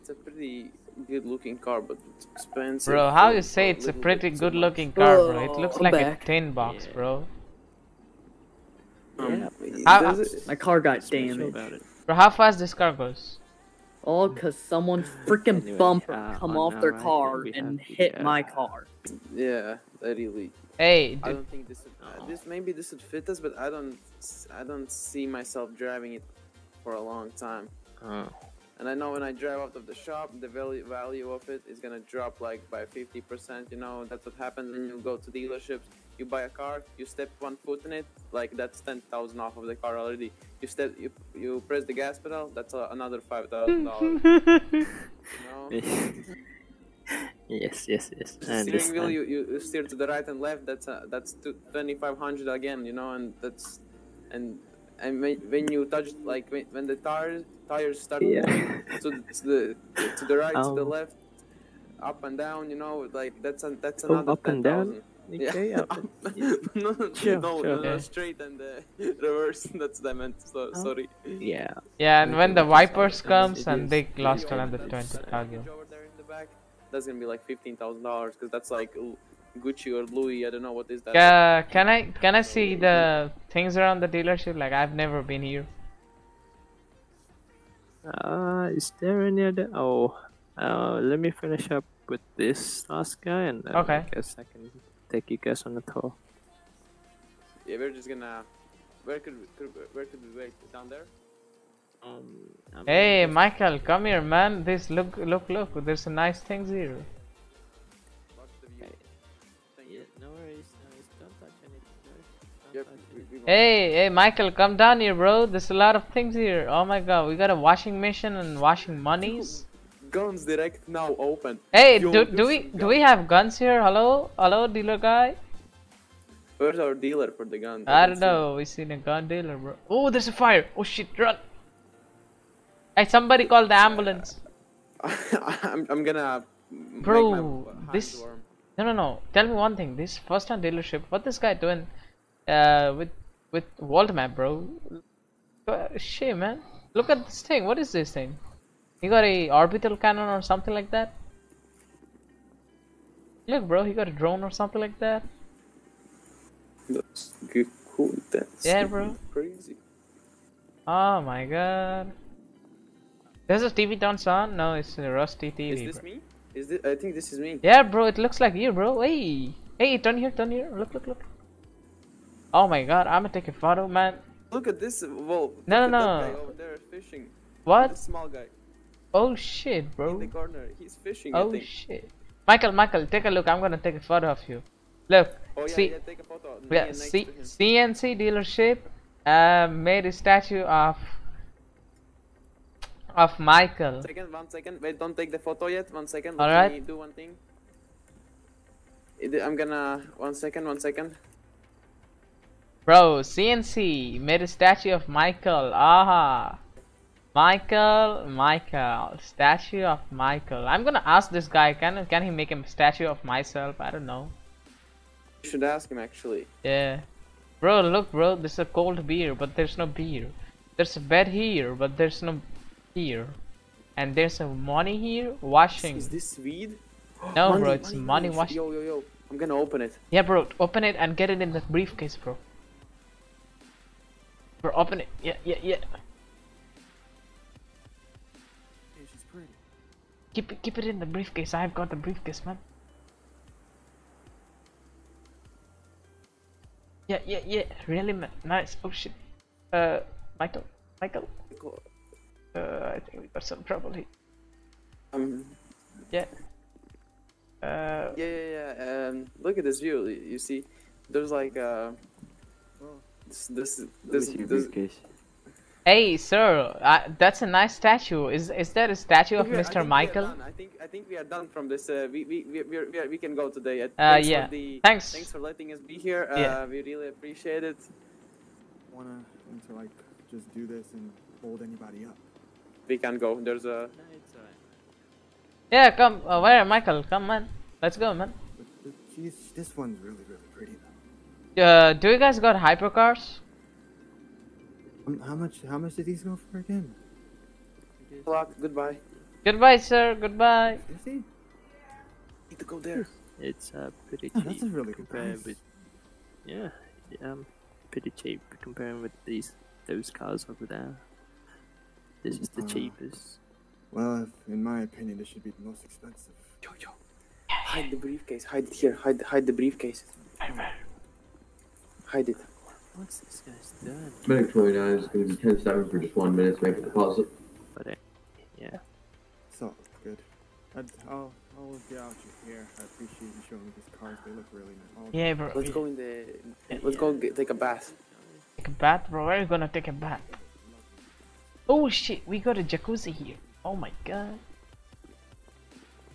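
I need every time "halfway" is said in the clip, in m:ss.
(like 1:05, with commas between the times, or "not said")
not said.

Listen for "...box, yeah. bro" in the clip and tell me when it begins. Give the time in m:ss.
0:06.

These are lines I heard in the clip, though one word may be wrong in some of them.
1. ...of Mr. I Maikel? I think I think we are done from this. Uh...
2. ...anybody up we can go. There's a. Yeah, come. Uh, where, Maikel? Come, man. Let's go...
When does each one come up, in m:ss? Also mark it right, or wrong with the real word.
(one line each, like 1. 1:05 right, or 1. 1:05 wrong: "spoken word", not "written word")
1. 4:29 right
2. 4:41 right.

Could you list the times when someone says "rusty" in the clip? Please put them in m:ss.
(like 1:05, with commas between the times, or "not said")
2:45.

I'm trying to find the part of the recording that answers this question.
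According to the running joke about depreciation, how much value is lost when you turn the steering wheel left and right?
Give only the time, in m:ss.
0:51.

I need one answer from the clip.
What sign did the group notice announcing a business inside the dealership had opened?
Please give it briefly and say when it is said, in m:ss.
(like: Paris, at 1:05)
Guns direct, at 2:00.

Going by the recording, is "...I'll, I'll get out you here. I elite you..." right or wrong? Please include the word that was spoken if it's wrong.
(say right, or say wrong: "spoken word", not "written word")
wrong: "appreciate", not "elite".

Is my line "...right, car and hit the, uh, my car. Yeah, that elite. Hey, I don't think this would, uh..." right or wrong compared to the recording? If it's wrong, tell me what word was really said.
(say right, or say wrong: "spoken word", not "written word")
right.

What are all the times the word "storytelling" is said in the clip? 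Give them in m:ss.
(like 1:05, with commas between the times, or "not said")
not said.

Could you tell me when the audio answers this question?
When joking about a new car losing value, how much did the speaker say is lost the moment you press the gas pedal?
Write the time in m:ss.
0:43.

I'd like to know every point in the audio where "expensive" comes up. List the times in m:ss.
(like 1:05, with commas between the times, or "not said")
0:02, 5:15.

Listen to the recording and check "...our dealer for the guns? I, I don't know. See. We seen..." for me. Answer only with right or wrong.
right.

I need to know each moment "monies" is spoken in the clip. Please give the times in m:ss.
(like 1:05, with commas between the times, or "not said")
1:58.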